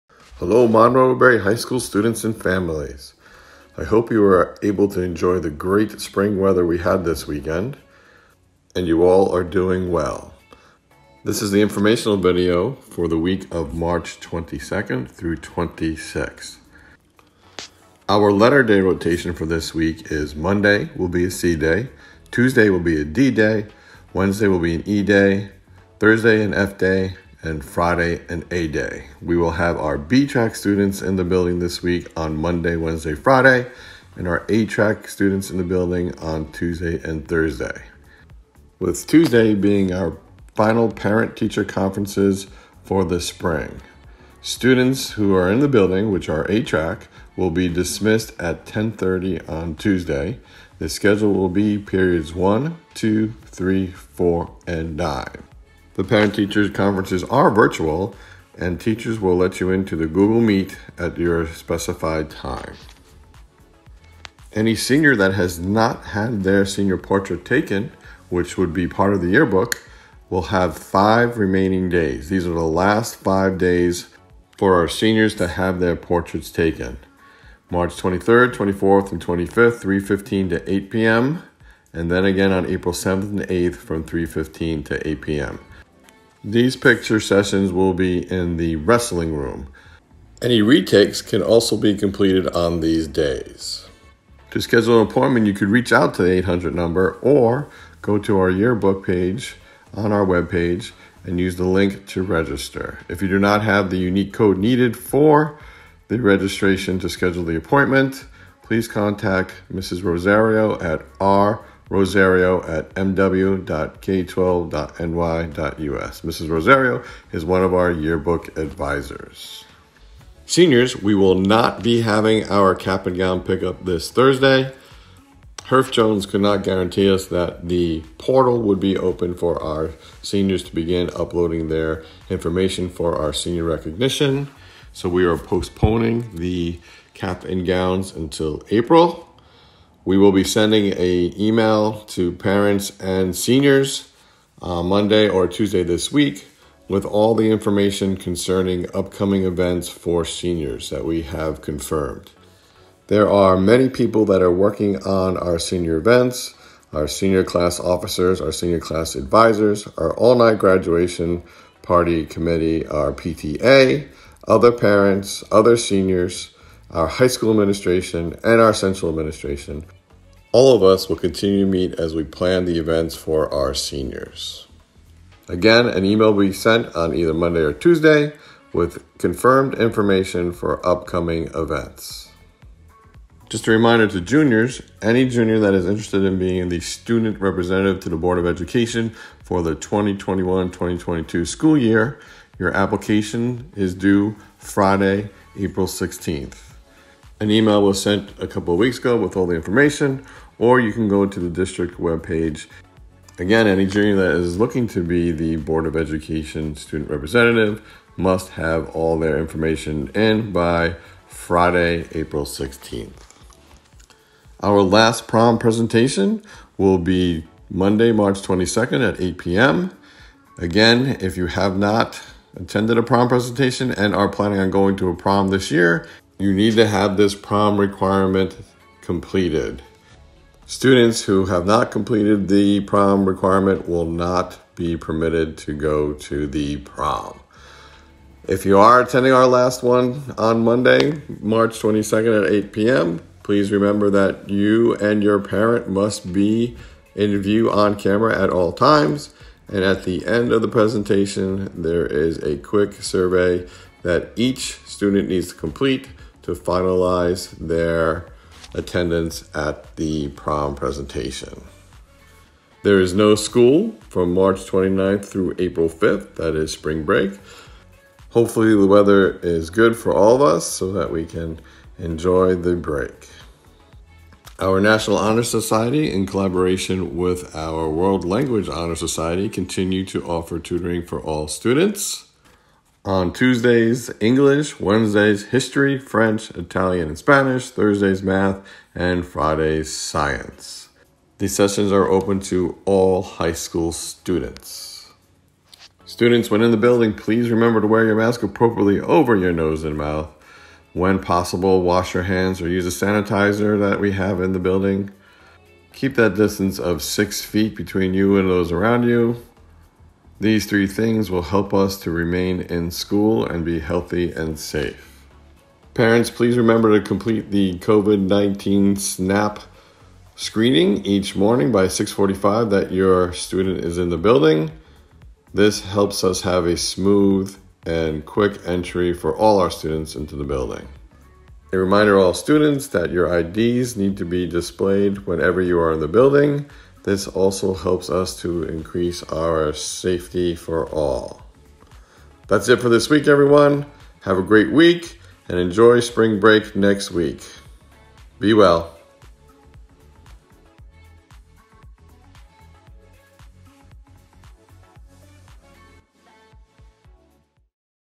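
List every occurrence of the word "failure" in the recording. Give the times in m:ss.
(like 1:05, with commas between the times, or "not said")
not said.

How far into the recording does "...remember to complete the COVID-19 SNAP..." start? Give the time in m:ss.
5:16.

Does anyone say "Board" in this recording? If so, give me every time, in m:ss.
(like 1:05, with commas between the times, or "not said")
3:08, 3:25.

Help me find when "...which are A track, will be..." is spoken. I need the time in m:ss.
0:46.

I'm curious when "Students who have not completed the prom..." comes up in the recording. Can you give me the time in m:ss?
3:50.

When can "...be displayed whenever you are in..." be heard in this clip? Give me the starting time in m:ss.
5:34.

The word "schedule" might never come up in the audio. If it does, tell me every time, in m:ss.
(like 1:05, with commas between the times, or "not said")
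0:50, 1:34, 1:47.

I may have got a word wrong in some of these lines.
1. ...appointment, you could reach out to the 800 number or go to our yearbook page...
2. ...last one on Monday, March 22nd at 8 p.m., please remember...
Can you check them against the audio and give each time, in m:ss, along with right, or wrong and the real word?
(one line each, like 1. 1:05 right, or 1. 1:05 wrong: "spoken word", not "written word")
1. 1:35 right
2. 3:59 right.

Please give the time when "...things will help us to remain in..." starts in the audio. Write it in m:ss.
5:10.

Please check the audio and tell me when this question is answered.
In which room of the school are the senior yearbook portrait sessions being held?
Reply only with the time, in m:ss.
1:28.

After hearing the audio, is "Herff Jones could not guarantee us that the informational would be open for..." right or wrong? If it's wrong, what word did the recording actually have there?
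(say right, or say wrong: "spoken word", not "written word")
wrong: "portal", not "informational".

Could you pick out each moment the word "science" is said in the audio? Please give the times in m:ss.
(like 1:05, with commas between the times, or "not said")
4:49.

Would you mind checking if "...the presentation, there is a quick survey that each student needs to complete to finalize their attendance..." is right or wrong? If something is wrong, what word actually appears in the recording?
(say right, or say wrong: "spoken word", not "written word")
right.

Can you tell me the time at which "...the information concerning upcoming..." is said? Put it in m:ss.
2:27.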